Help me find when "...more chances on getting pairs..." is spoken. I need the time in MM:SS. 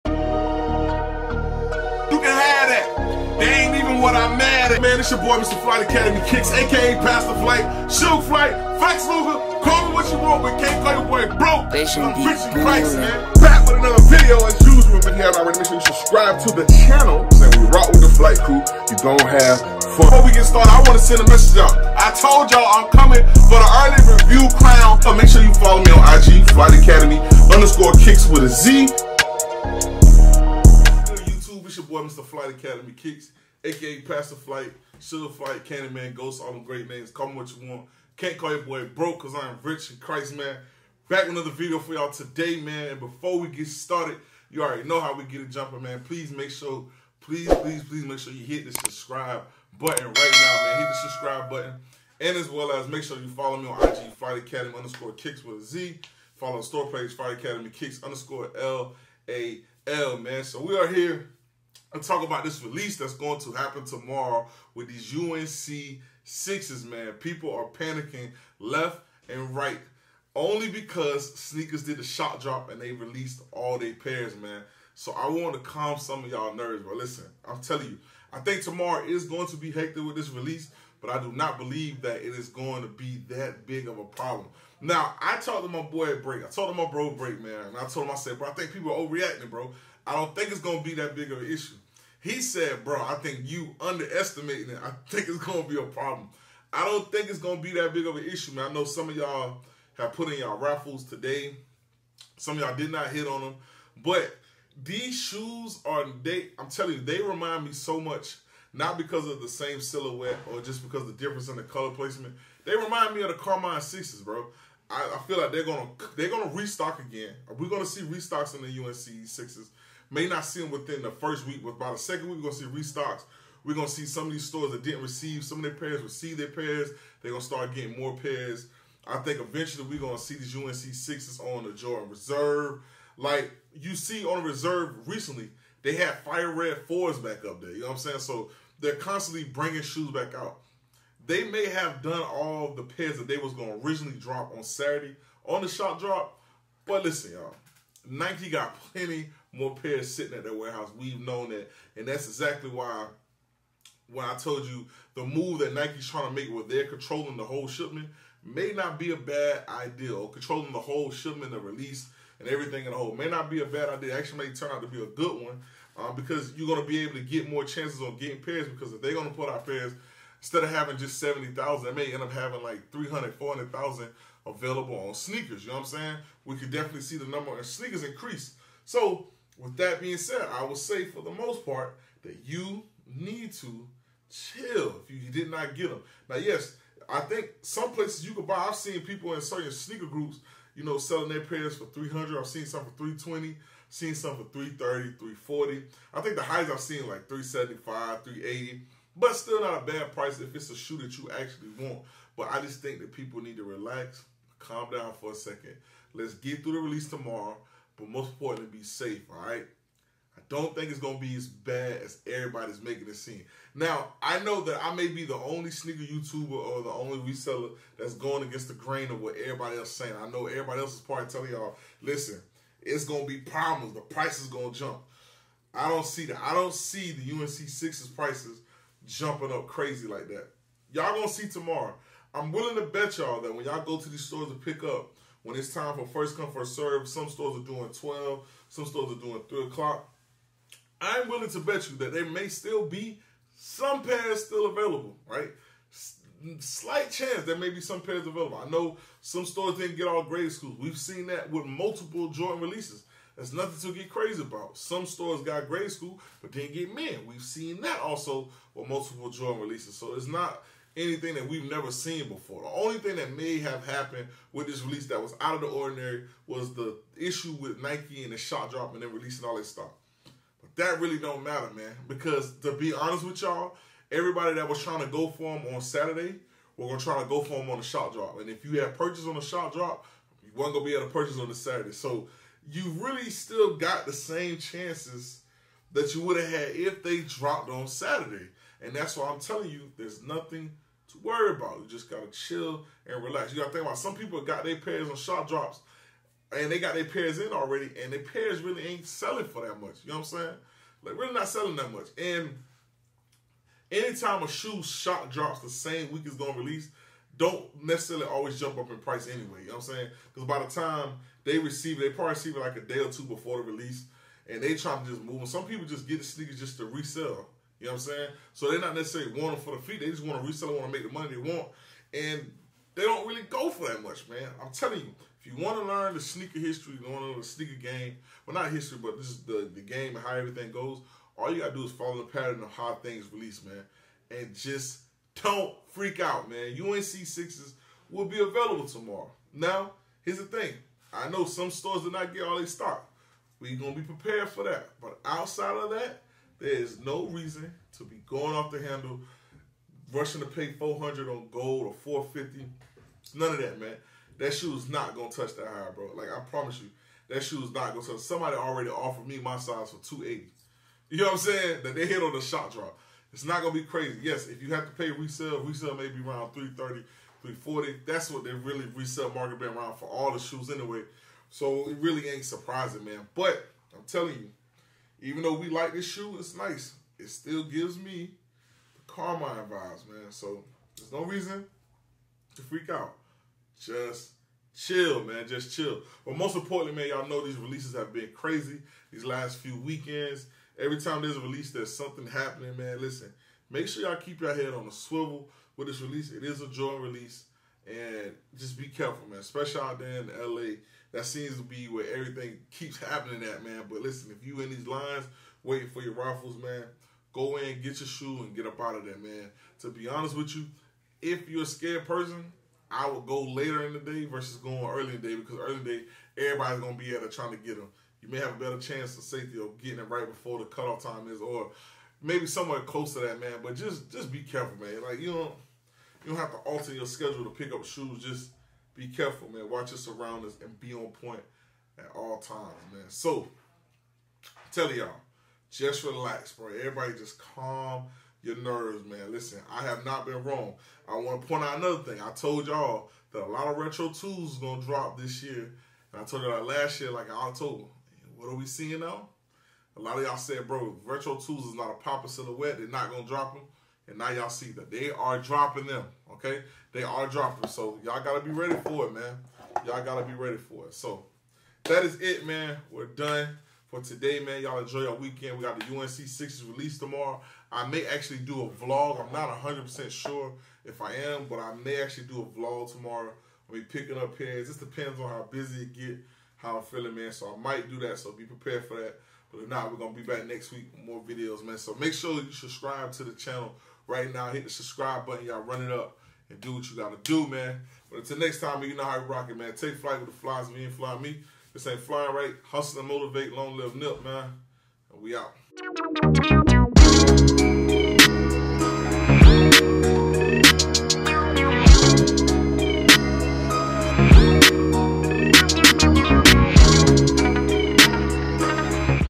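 02:47.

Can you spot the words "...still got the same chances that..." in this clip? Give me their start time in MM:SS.
04:43.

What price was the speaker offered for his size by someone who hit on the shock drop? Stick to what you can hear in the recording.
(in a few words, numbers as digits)
280.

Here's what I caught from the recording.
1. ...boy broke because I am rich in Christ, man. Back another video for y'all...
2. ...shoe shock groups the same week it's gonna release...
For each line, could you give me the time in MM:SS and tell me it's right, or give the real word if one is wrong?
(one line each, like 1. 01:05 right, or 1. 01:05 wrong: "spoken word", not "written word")
1. 00:38 right
2. 05:04 wrong: "drops", not "groups".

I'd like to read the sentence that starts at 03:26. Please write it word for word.
Let's get through the release tomorrow, but most importantly, be safe, all right?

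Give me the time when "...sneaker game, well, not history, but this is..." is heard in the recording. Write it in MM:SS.
05:27.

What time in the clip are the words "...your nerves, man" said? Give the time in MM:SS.
07:18.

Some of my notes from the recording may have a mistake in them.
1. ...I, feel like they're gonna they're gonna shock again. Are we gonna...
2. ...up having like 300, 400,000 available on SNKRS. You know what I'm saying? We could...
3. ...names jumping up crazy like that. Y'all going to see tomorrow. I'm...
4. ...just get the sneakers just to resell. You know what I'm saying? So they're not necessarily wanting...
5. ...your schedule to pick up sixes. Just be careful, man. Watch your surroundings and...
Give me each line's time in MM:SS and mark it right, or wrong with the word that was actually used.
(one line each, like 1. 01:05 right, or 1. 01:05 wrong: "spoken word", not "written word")
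1. 01:55 wrong: "restock", not "shock"
2. 02:52 right
3. 03:48 wrong: "prices", not "names"
4. 05:15 right
5. 07:06 wrong: "shoes", not "sixes".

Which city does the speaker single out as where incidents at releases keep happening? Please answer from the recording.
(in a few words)
LA.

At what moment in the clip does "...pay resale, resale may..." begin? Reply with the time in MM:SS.
06:04.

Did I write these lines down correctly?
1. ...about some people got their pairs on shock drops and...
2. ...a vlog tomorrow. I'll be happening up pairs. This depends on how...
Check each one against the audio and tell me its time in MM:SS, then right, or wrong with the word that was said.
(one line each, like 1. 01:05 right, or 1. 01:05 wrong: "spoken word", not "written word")
1. 04:53 right
2. 07:52 wrong: "picking", not "happening".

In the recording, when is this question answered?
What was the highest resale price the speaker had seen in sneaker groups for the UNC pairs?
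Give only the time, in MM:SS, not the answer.
03:18.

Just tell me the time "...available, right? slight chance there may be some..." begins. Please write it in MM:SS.
04:04.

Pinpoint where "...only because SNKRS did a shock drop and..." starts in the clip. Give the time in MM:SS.
01:10.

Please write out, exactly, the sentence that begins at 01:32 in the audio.
He said, bro, I think you underestimating it.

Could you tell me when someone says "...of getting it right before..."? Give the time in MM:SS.
06:59.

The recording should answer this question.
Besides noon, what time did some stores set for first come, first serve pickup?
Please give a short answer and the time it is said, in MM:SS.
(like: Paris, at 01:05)
3 o'clock, at 03:59.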